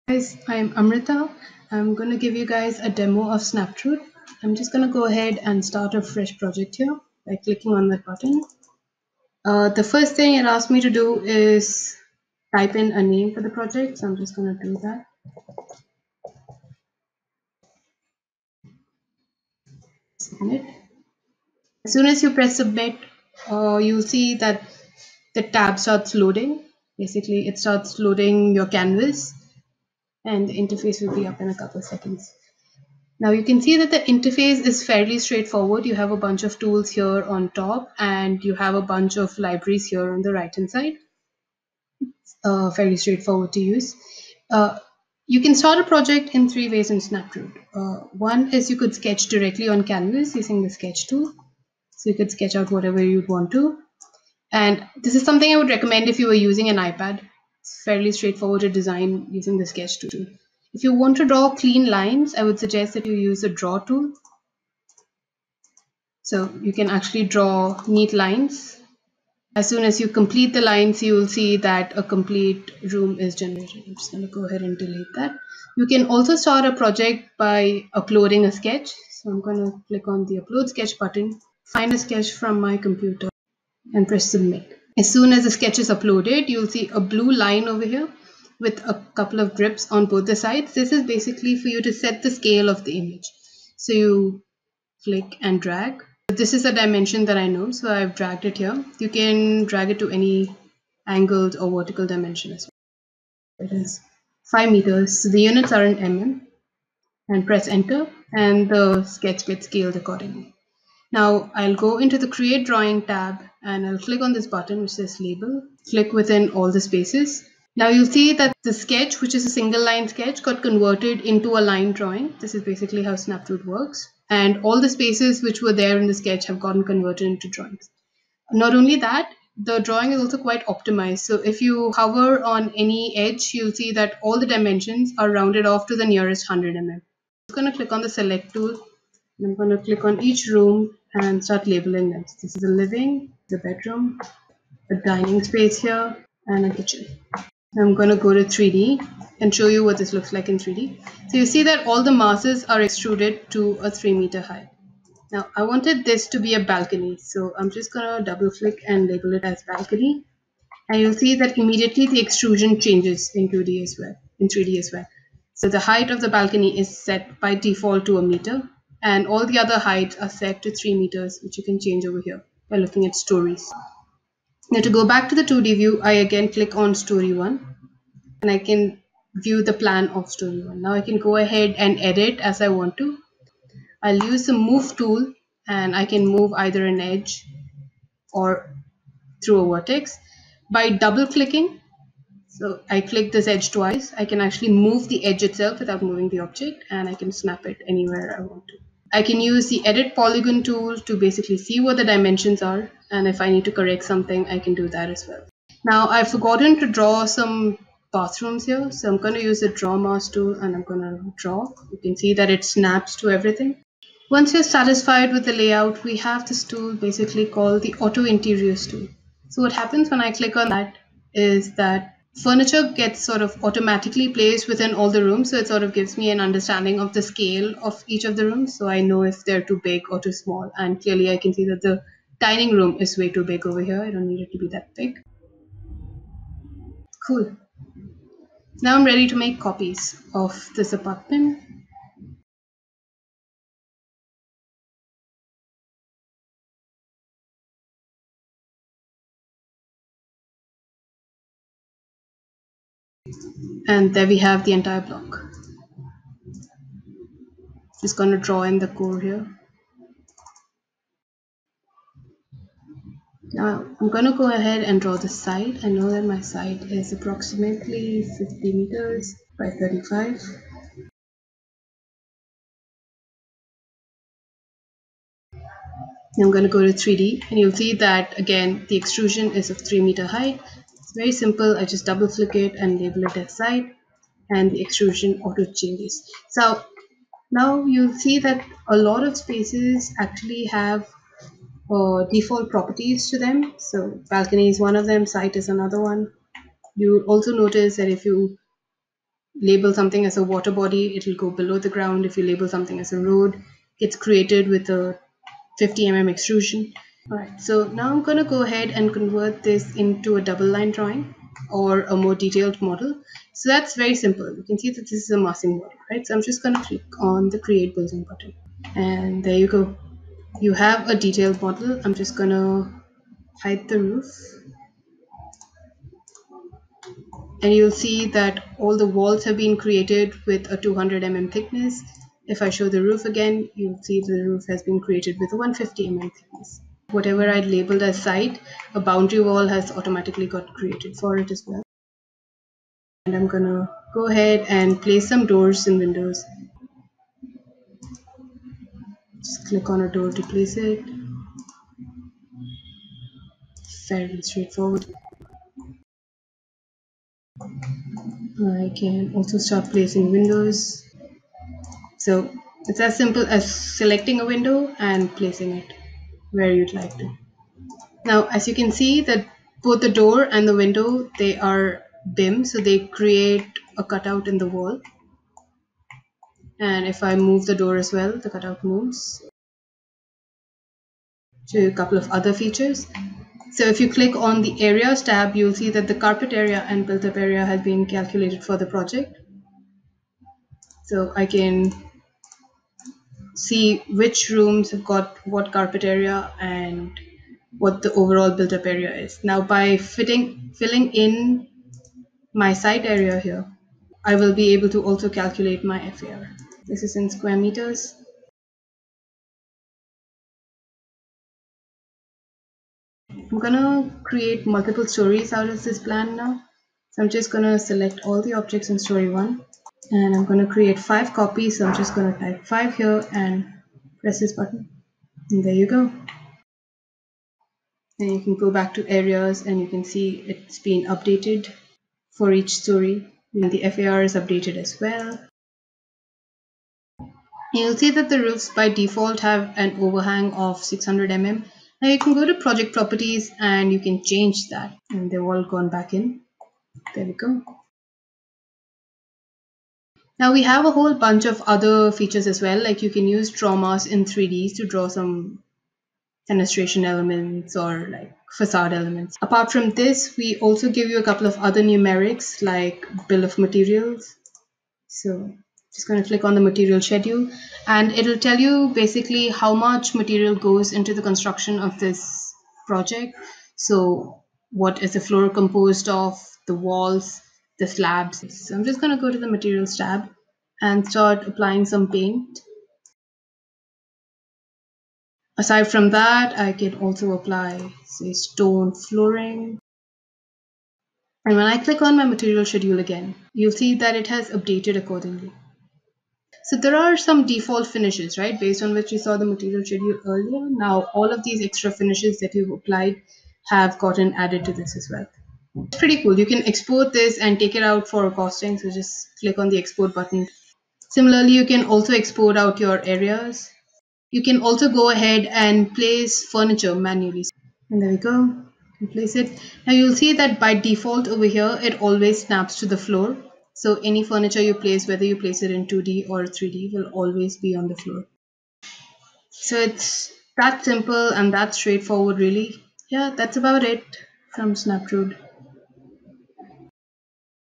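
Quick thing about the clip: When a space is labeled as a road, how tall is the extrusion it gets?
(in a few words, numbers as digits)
50 mm.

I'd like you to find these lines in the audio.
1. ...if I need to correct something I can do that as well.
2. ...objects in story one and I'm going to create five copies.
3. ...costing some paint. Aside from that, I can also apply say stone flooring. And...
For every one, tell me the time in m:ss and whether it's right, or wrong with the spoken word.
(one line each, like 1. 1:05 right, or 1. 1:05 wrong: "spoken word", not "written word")
1. 3:23 right
2. 6:58 right
3. 8:01 wrong: "applying", not "costing".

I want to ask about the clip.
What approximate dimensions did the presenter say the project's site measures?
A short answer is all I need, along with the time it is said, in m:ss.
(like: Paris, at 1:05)
50 by 35 meters, at 4:28.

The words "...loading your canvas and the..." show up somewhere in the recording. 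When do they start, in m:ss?
0:27.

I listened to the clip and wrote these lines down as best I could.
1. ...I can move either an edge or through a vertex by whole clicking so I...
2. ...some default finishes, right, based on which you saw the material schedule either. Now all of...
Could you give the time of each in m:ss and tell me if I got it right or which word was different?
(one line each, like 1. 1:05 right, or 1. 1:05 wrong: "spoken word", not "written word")
1. 3:05 wrong: "double", not "whole"
2. 8:17 wrong: "earlier", not "either".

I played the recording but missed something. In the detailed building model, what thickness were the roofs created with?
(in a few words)
150 mm.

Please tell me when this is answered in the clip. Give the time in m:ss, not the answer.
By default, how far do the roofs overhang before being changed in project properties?
7:20.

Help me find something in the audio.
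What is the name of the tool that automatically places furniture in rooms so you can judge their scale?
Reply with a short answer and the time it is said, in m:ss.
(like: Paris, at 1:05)
auto interiors tool, at 3:37.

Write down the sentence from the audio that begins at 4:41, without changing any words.
I just double click it and label it as side and the extrusion auto changes.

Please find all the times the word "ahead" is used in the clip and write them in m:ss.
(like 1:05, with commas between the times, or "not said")
0:05, 1:14, 3:01, 4:24, 5:08, 5:44, 8:35.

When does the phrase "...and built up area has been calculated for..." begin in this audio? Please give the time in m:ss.
6:26.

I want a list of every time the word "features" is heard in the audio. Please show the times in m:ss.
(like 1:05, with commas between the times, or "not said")
6:22, 7:32.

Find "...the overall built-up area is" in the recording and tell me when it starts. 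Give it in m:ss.
6:38.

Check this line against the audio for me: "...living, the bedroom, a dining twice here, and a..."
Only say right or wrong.
wrong.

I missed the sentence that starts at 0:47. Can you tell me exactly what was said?
Uh, one is you could sketch directly on canvas using the sketch tool.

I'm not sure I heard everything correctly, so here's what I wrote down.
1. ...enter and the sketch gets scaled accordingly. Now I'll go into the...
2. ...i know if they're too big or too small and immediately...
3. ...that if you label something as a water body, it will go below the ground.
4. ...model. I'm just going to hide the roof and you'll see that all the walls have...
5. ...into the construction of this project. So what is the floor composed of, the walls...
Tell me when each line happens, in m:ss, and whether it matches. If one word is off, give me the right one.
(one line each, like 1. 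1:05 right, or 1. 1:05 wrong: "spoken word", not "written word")
1. 1:47 right
2. 3:48 wrong: "clearly", not "immediately"
3. 4:57 right
4. 5:21 right
5. 7:50 right.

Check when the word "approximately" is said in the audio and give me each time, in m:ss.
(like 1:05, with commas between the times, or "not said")
4:27.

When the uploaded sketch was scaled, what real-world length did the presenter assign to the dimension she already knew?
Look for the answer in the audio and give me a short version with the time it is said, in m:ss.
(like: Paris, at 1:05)
5 meters, at 1:44.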